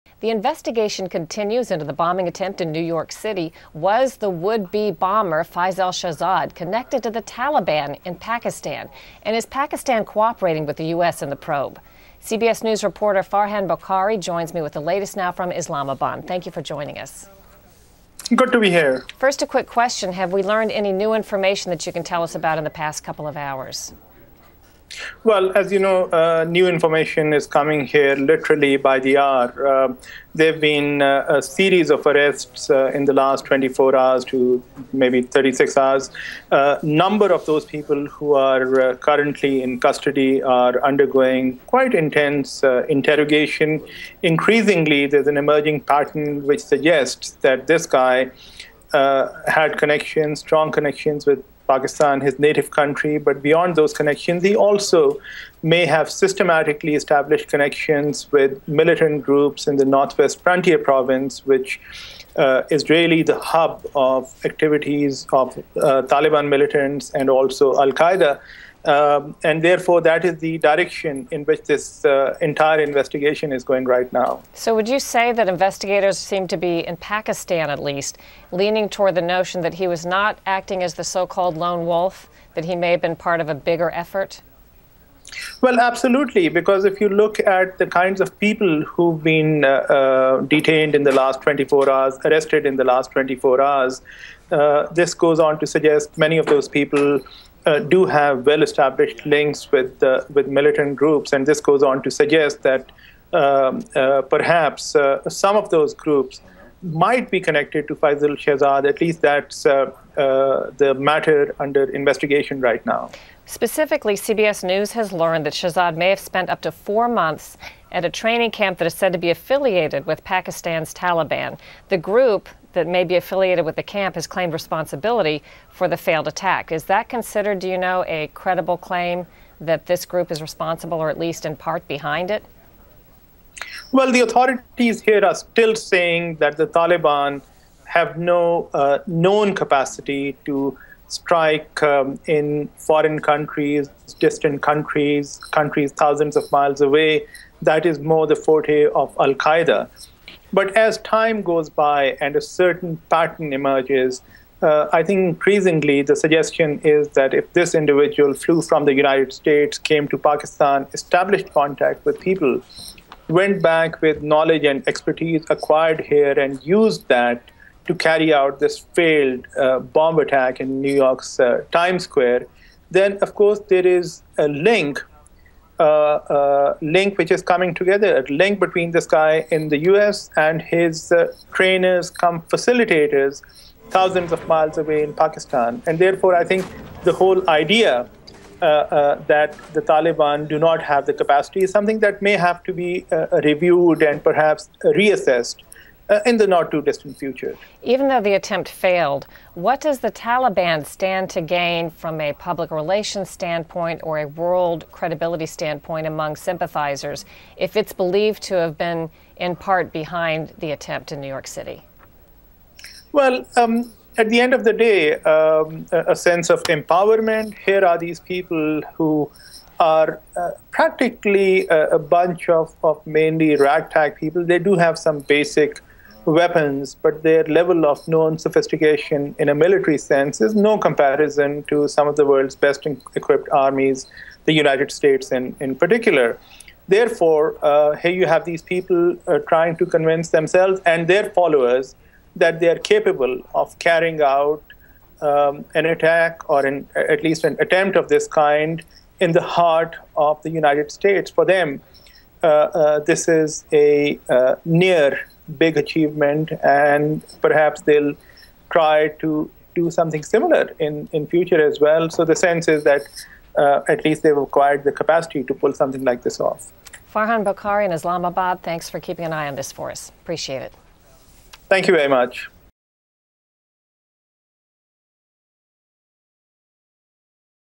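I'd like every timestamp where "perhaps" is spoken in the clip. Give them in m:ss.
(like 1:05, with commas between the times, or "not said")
1:44, 3:14, 4:17.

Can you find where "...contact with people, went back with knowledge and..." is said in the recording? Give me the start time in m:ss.
2:41.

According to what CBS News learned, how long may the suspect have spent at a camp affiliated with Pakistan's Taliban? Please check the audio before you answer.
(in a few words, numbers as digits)
4 months.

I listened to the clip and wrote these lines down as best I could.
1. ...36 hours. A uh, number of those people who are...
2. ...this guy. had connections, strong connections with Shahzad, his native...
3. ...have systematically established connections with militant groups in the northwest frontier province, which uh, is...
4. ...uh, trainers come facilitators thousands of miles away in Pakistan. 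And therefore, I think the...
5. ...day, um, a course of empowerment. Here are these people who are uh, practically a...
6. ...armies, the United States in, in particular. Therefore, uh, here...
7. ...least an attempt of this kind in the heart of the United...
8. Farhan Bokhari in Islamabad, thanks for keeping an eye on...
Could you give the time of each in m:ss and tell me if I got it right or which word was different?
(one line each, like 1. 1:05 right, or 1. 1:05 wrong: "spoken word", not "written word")
1. 0:35 right
2. 0:47 wrong: "Pakistan", not "Shahzad"
3. 0:55 right
4. 3:01 right
5. 3:34 wrong: "sense", not "course"
6. 3:53 right
7. 4:07 right
8. 4:27 right.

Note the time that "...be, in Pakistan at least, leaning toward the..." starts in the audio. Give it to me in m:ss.
1:16.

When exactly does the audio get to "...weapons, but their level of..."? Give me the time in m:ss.
3:46.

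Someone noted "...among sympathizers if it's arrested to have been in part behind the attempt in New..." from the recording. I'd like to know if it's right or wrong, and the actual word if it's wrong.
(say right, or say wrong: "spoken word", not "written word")
wrong: "believed", not "arrested".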